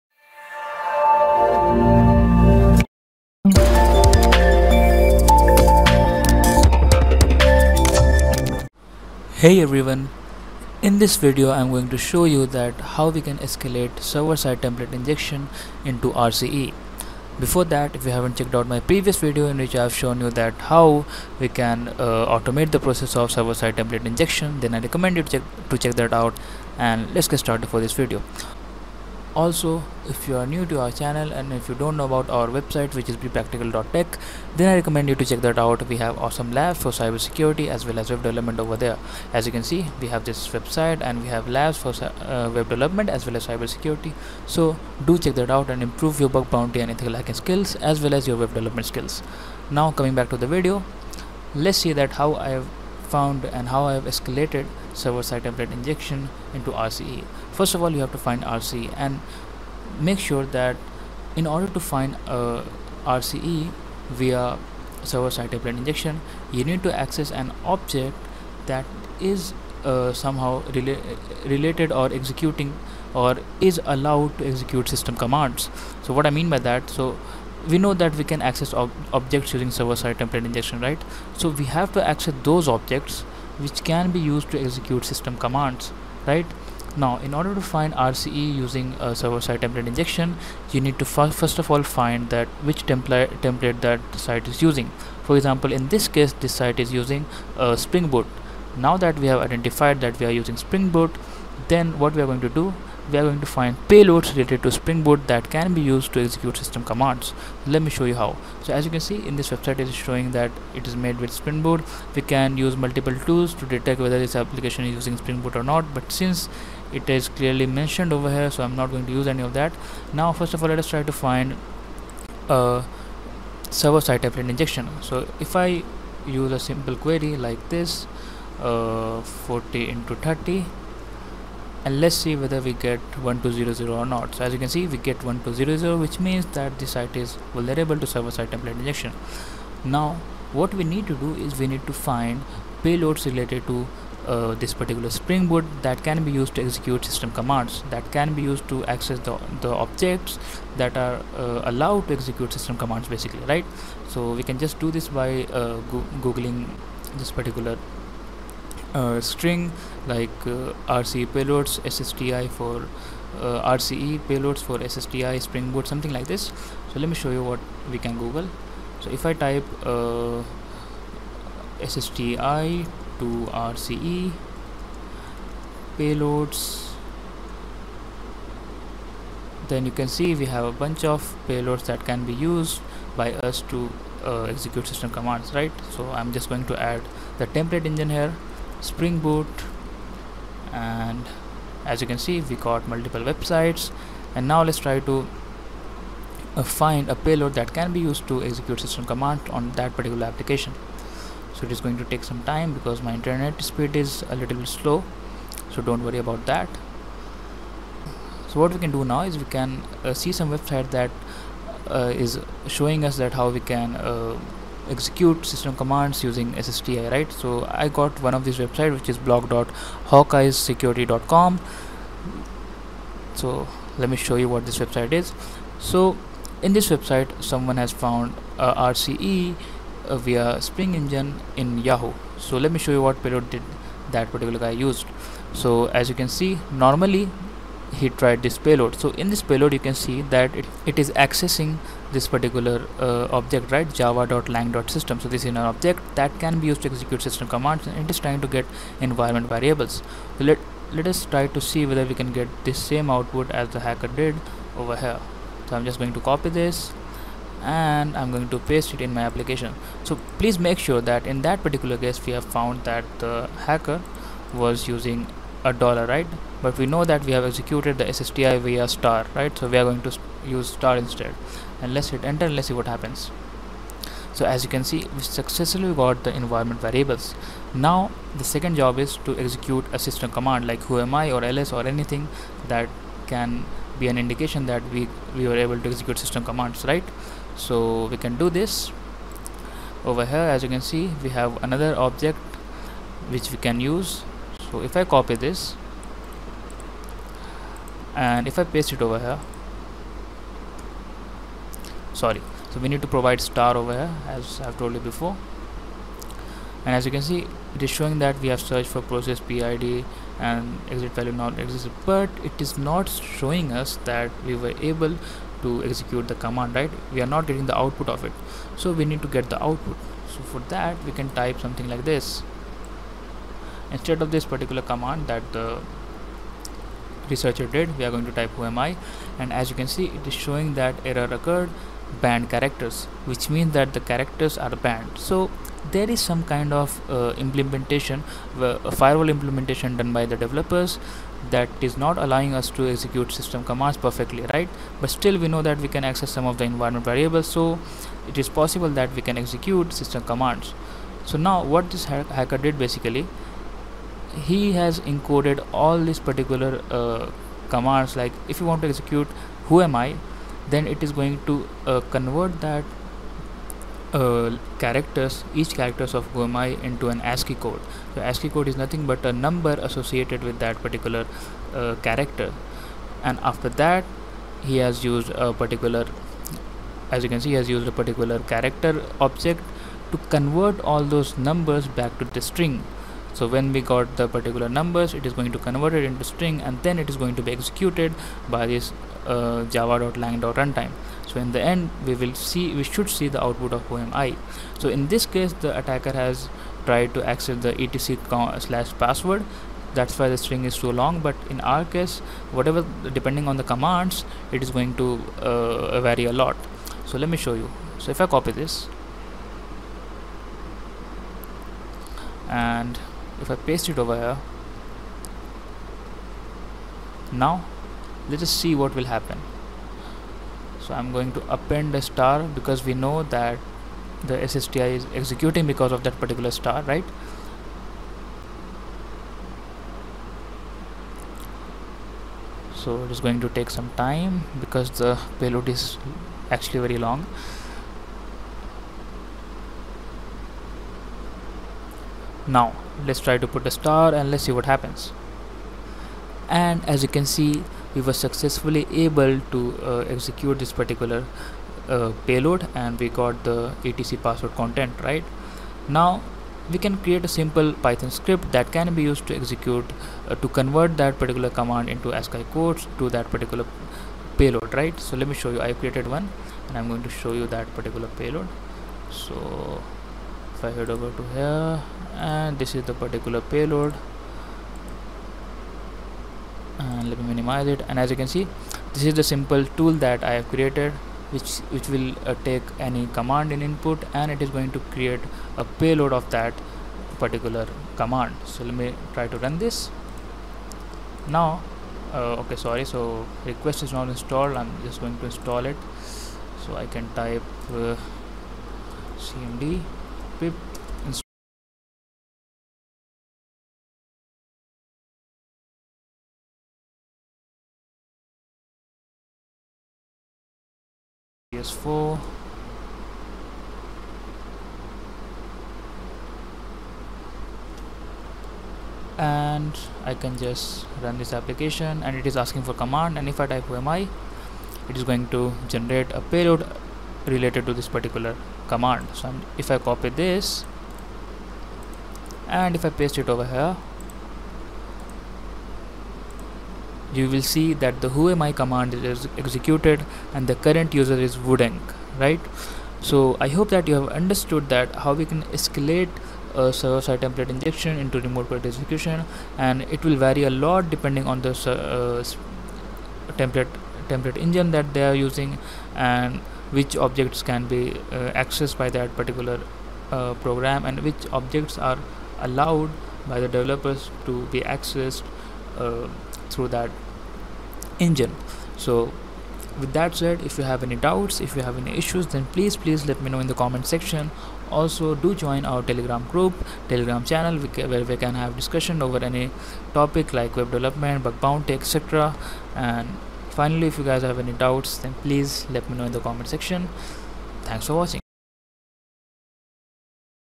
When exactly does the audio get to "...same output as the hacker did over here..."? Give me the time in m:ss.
4:12.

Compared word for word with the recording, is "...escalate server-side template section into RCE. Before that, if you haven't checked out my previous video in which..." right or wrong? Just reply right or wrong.
wrong.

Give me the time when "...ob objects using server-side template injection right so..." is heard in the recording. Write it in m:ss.
1:18.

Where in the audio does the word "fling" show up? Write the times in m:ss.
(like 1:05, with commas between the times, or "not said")
not said.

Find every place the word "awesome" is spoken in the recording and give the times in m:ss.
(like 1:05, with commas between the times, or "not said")
0:36.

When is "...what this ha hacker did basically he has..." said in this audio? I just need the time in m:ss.
5:51.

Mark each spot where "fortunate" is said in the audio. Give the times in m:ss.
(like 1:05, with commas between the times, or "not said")
not said.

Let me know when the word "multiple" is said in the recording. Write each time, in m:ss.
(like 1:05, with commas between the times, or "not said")
1:52, 3:12.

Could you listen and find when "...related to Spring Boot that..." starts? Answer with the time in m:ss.
1:44.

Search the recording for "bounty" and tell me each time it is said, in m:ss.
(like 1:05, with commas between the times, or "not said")
0:46, 9:41.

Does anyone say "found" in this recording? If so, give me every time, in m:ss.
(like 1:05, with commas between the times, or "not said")
0:53, 3:47, 4:22.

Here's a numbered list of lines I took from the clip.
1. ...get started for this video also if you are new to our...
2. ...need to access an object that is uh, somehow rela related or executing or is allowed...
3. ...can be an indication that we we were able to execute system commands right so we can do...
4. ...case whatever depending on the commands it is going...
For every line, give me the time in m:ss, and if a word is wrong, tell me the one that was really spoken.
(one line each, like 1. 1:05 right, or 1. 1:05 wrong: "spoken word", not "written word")
1. 0:27 right
2. 1:06 right
3. 4:43 right
4. 6:41 right.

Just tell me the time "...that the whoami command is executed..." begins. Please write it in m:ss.
8:57.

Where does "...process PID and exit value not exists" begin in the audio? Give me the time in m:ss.
5:09.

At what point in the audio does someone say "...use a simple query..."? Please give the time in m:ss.
2:06.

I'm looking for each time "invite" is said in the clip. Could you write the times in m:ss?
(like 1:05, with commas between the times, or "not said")
not said.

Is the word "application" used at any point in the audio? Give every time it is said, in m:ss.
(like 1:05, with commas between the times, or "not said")
1:54, 3:20, 4:19, 8:41.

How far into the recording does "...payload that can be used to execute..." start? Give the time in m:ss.
3:17.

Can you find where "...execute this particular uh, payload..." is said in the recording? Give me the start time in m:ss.
7:30.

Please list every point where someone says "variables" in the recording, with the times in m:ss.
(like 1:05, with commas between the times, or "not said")
4:09, 4:36, 5:47.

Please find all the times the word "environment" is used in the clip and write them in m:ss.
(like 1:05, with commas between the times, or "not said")
4:09, 4:36, 5:46.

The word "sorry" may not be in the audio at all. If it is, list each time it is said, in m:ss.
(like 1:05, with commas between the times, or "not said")
5:02, 8:12.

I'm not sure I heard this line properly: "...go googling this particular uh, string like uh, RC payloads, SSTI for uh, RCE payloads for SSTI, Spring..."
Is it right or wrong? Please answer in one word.
right.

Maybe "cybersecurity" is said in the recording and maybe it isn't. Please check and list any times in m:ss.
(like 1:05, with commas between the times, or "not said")
0:36, 0:43.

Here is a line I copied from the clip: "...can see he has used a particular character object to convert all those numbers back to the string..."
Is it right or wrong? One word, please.
right.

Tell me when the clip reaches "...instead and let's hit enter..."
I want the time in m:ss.
4:31.